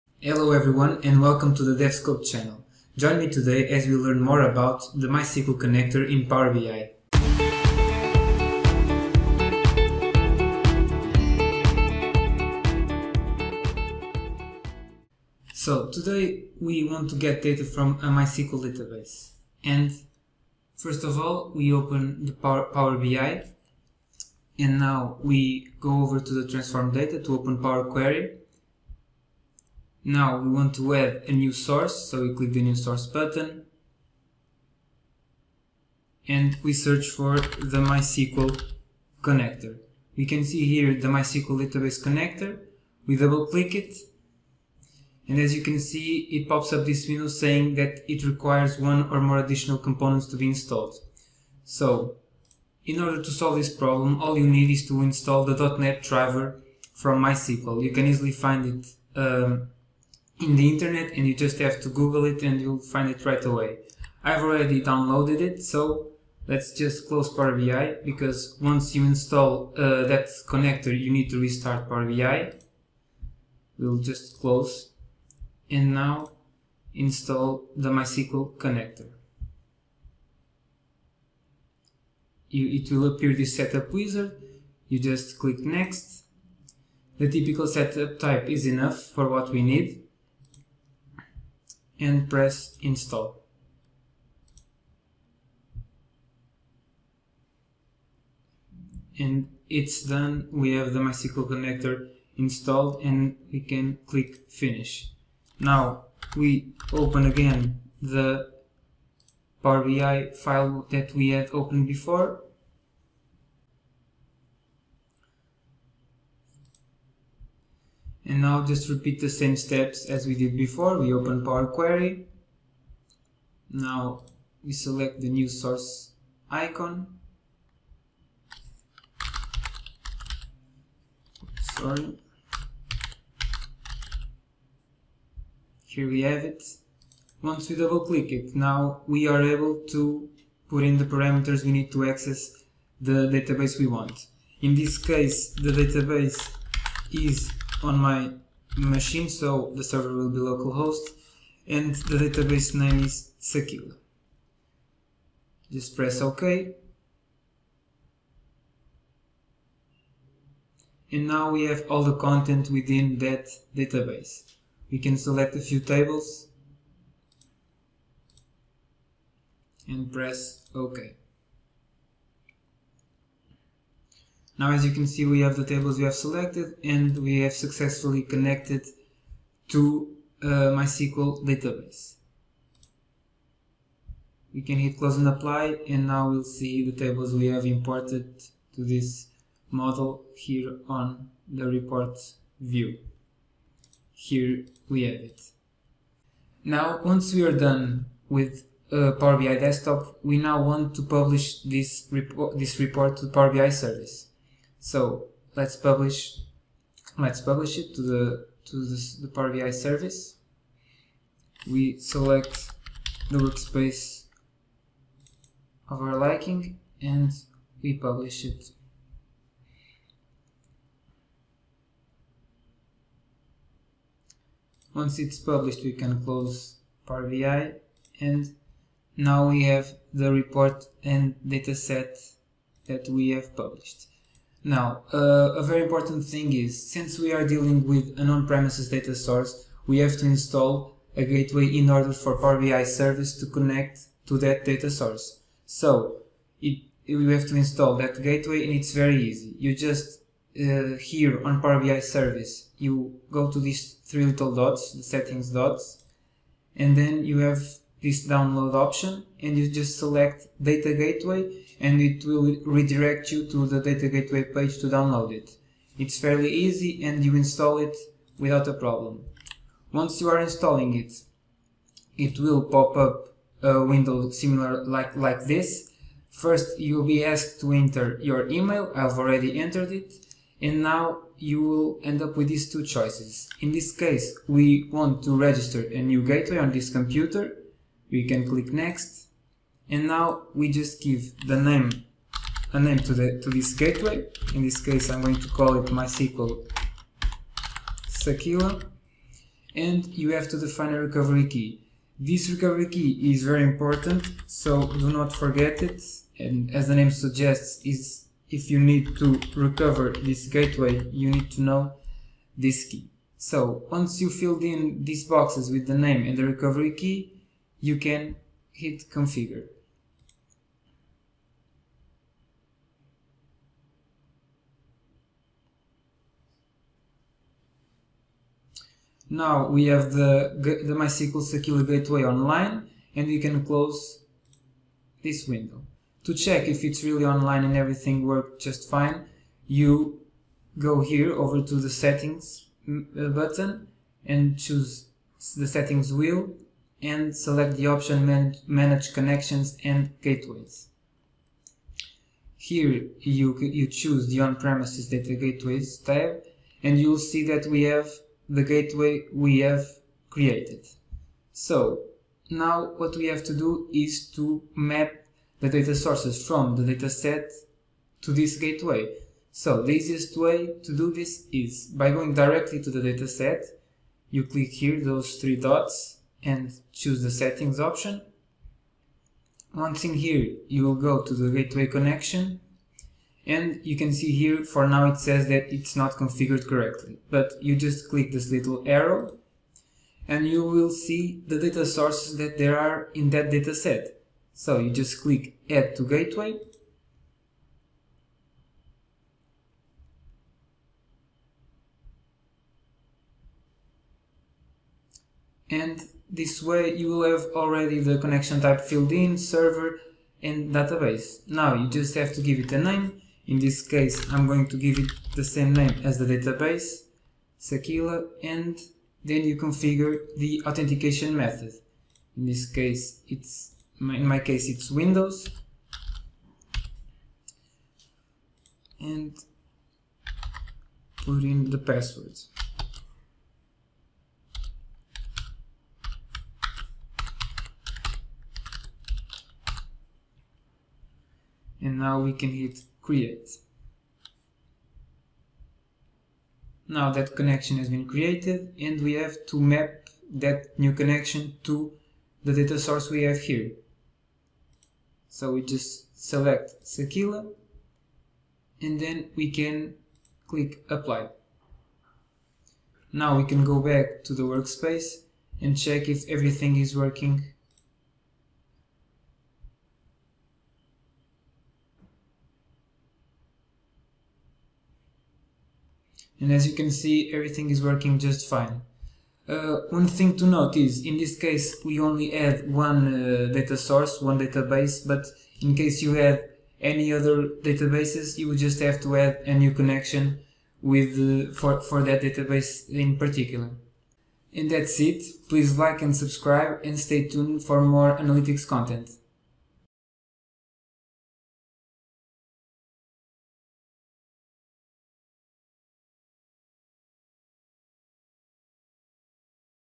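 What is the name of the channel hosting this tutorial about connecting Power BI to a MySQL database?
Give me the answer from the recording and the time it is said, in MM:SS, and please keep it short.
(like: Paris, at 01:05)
DevScope, at 00:01.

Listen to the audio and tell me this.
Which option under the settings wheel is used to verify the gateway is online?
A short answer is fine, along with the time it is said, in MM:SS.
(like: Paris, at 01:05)
Manage Connections and Gateways, at 05:48.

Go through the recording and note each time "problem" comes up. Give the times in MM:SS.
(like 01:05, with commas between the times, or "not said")
00:53, 04:28.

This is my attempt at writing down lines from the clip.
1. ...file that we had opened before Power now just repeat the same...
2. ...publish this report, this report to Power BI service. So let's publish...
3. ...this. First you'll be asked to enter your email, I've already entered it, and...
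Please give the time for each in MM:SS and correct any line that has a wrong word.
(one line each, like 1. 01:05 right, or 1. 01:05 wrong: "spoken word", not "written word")
1. 01:50 wrong: "And", not "Power"
2. 03:21 right
3. 04:35 right.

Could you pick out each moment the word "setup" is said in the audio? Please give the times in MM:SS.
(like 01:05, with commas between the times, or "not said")
01:23, 01:27.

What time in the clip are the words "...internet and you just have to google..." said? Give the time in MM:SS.
01:00.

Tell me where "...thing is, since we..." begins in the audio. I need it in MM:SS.
03:56.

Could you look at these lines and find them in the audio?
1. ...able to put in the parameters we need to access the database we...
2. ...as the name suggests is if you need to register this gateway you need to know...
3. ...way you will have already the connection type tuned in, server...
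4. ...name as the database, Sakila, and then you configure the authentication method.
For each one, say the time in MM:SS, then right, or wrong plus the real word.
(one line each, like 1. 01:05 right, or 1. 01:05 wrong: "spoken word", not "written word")
1. 02:19 right
2. 05:06 wrong: "recover", not "register"
3. 06:46 wrong: "filled", not "tuned"
4. 06:55 right.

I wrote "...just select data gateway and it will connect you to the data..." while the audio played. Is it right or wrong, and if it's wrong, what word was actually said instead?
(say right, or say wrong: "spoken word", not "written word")
wrong: "redirect", not "connect".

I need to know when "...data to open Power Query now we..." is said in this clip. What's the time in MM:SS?
00:26.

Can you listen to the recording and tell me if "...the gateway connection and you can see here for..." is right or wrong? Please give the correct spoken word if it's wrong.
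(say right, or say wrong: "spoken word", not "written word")
right.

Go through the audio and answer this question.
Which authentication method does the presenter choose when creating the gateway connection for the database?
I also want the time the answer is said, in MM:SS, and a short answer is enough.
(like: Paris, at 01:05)
Windows, at 07:04.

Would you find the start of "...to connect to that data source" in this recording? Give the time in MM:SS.
04:03.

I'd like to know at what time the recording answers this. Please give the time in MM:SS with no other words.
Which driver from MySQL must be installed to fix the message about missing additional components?
00:55.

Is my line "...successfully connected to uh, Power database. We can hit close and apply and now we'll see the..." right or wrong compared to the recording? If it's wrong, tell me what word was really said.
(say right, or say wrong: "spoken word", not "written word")
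wrong: "MySQL", not "Power".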